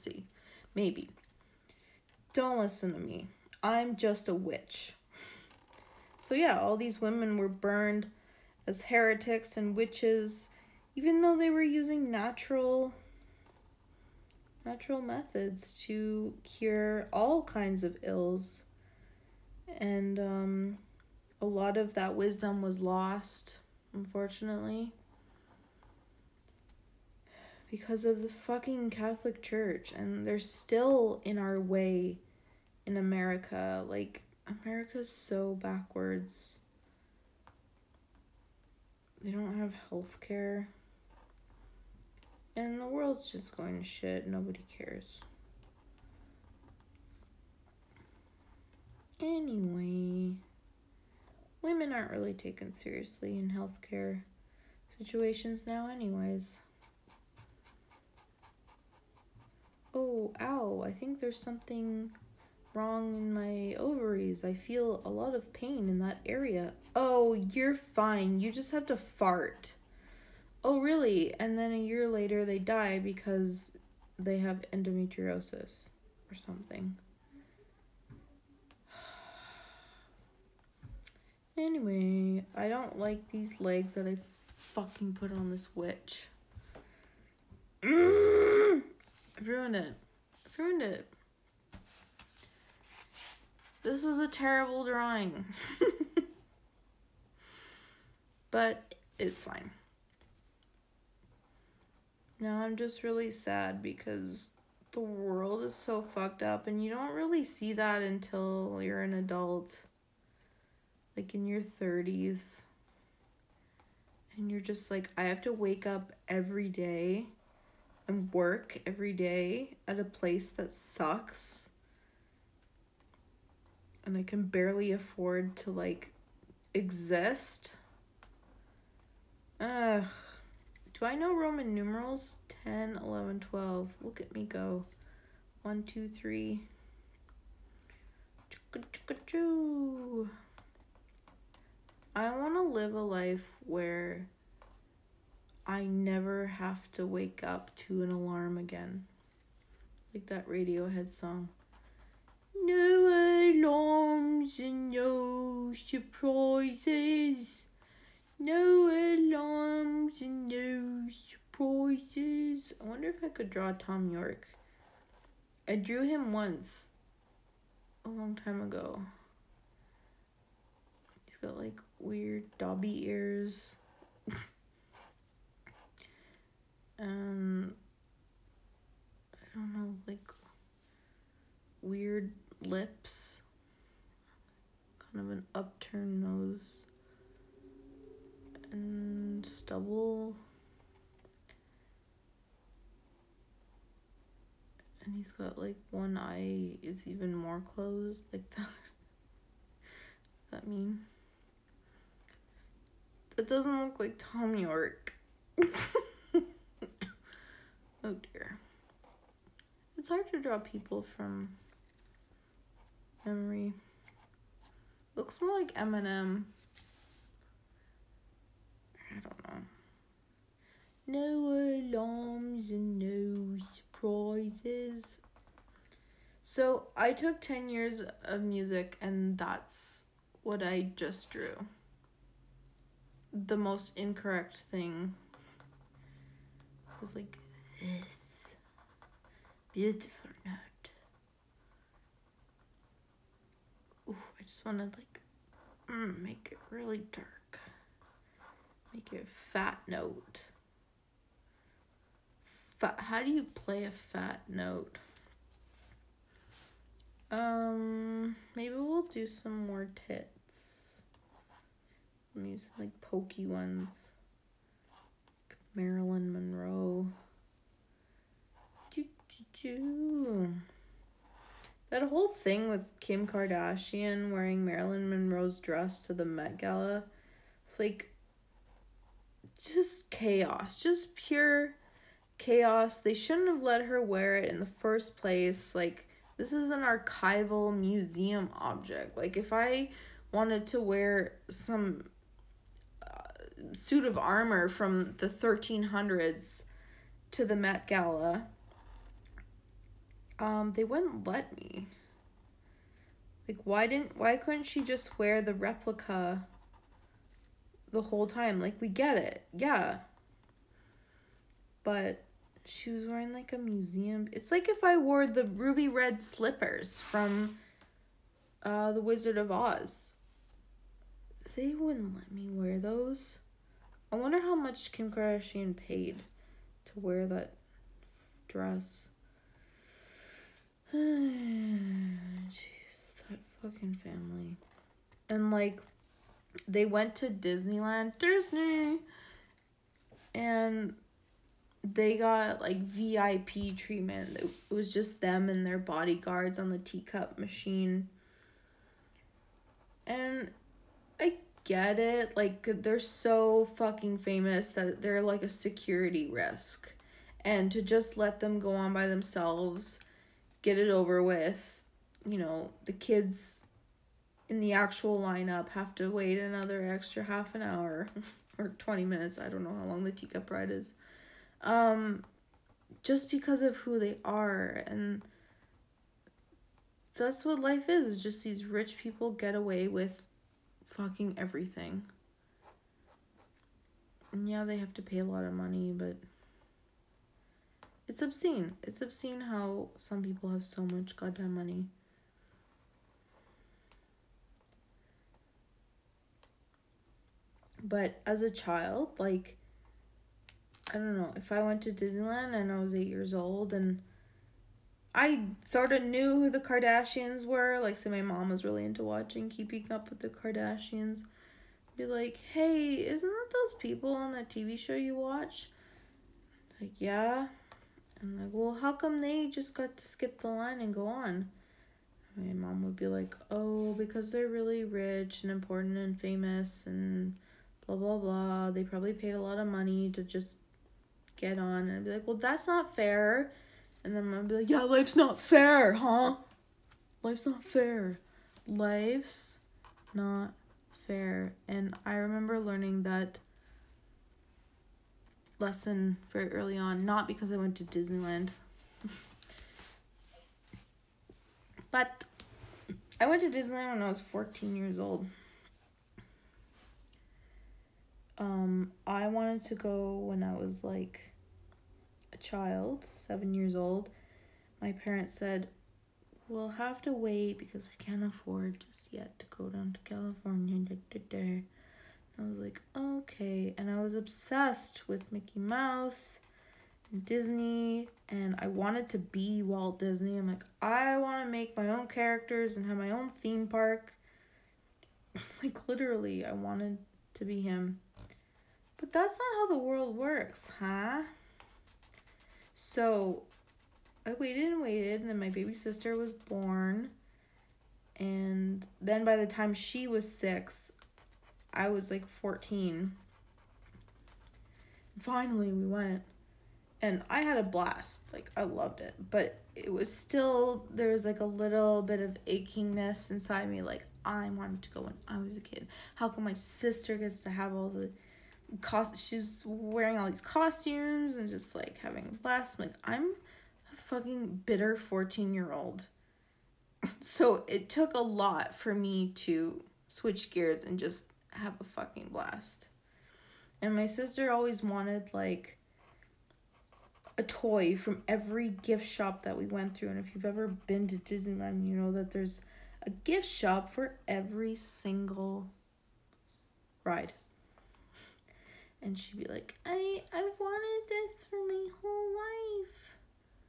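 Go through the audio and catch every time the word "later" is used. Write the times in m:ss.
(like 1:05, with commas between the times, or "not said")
1:12.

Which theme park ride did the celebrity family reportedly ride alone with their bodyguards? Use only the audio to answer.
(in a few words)
teacup ride.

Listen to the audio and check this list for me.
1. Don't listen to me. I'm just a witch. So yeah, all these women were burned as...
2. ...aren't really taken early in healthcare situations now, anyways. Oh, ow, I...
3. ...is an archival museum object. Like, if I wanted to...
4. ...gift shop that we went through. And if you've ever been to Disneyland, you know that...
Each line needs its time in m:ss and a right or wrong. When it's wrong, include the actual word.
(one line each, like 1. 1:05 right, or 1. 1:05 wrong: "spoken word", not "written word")
1. 0:02 right
2. 0:51 wrong: "seriously", not "early"
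3. 4:46 right
4. 8:58 right.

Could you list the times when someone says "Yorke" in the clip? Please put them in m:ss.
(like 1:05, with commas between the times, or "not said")
2:44, 3:24.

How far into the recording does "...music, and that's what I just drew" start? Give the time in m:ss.
3:48.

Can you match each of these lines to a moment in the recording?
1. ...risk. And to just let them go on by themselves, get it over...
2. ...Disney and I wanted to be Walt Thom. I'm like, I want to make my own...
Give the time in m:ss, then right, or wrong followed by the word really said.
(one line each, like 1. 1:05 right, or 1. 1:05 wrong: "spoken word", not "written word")
1. 5:56 right
2. 7:57 wrong: "Disney", not "Thom".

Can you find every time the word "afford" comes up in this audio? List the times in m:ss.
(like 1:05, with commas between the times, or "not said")
2:04, 7:48.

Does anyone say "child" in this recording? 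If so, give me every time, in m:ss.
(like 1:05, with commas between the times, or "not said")
6:38, 7:42.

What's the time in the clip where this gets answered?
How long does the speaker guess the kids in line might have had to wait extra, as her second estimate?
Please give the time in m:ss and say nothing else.
6:08.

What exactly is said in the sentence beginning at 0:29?
And they're still in our way in America.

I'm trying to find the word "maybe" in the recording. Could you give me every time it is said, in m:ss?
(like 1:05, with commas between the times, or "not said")
0:00, 4:18.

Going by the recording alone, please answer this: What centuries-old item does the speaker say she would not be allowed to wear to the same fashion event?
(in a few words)
suit of armor.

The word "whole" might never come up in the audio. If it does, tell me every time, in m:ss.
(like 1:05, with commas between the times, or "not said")
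4:32, 5:08, 9:12.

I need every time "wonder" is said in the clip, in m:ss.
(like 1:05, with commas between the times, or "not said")
2:42, 5:24.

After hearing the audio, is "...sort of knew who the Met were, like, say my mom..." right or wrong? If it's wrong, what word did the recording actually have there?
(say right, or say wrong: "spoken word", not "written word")
wrong: "Kardashians", not "Met".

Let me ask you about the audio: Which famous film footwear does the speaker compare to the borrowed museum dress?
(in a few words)
ruby red slippers.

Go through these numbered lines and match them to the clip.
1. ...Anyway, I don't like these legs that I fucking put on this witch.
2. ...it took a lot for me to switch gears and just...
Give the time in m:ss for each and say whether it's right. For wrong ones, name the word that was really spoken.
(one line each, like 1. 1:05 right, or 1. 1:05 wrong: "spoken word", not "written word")
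1. 1:21 right
2. 8:47 right.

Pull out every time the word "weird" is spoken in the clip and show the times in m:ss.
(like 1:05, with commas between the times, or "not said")
2:51, 3:01.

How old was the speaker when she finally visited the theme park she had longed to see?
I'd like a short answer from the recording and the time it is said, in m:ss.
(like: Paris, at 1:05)
14, at 7:34.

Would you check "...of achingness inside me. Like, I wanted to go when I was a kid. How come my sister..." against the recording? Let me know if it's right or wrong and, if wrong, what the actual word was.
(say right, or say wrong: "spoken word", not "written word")
right.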